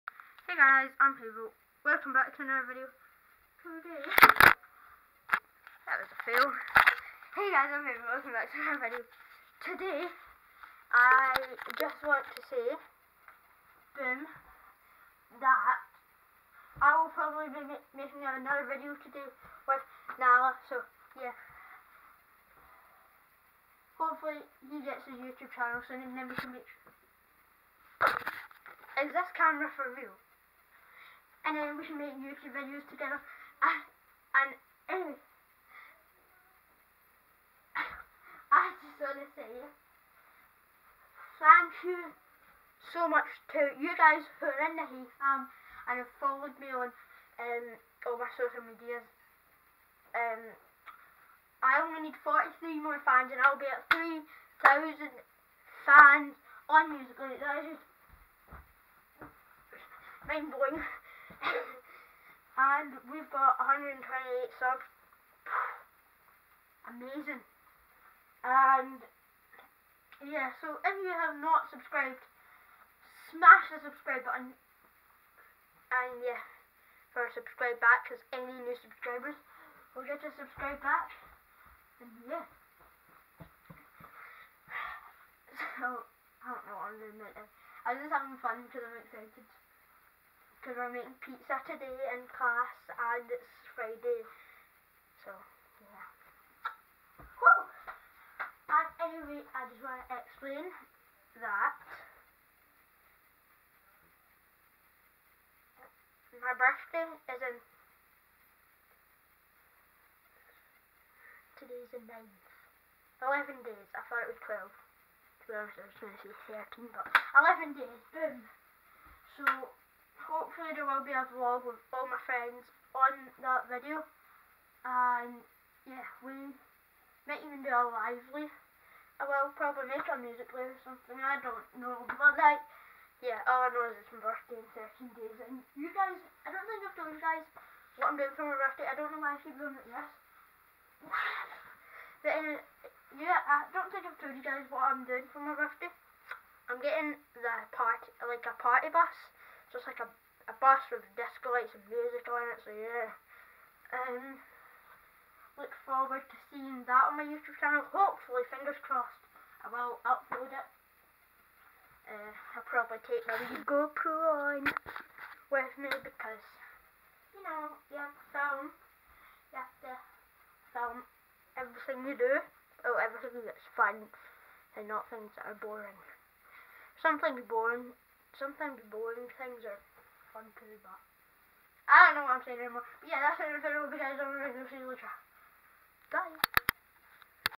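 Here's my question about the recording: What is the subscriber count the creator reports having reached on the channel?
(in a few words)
128.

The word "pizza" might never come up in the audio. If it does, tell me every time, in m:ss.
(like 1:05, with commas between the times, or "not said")
1:31.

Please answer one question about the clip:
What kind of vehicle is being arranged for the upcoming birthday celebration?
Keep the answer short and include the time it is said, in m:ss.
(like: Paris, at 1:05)
A party bus, at 2:28.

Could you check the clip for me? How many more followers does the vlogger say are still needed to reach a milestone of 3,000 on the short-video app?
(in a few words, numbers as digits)
43.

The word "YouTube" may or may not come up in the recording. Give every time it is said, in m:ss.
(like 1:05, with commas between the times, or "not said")
0:25, 0:32, 2:37.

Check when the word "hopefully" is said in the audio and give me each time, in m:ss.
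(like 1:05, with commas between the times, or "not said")
0:23, 2:37.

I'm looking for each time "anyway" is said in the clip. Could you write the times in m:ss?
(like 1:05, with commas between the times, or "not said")
0:34, 1:39.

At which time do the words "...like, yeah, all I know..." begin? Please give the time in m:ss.
2:12.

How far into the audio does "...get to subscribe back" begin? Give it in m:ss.
1:20.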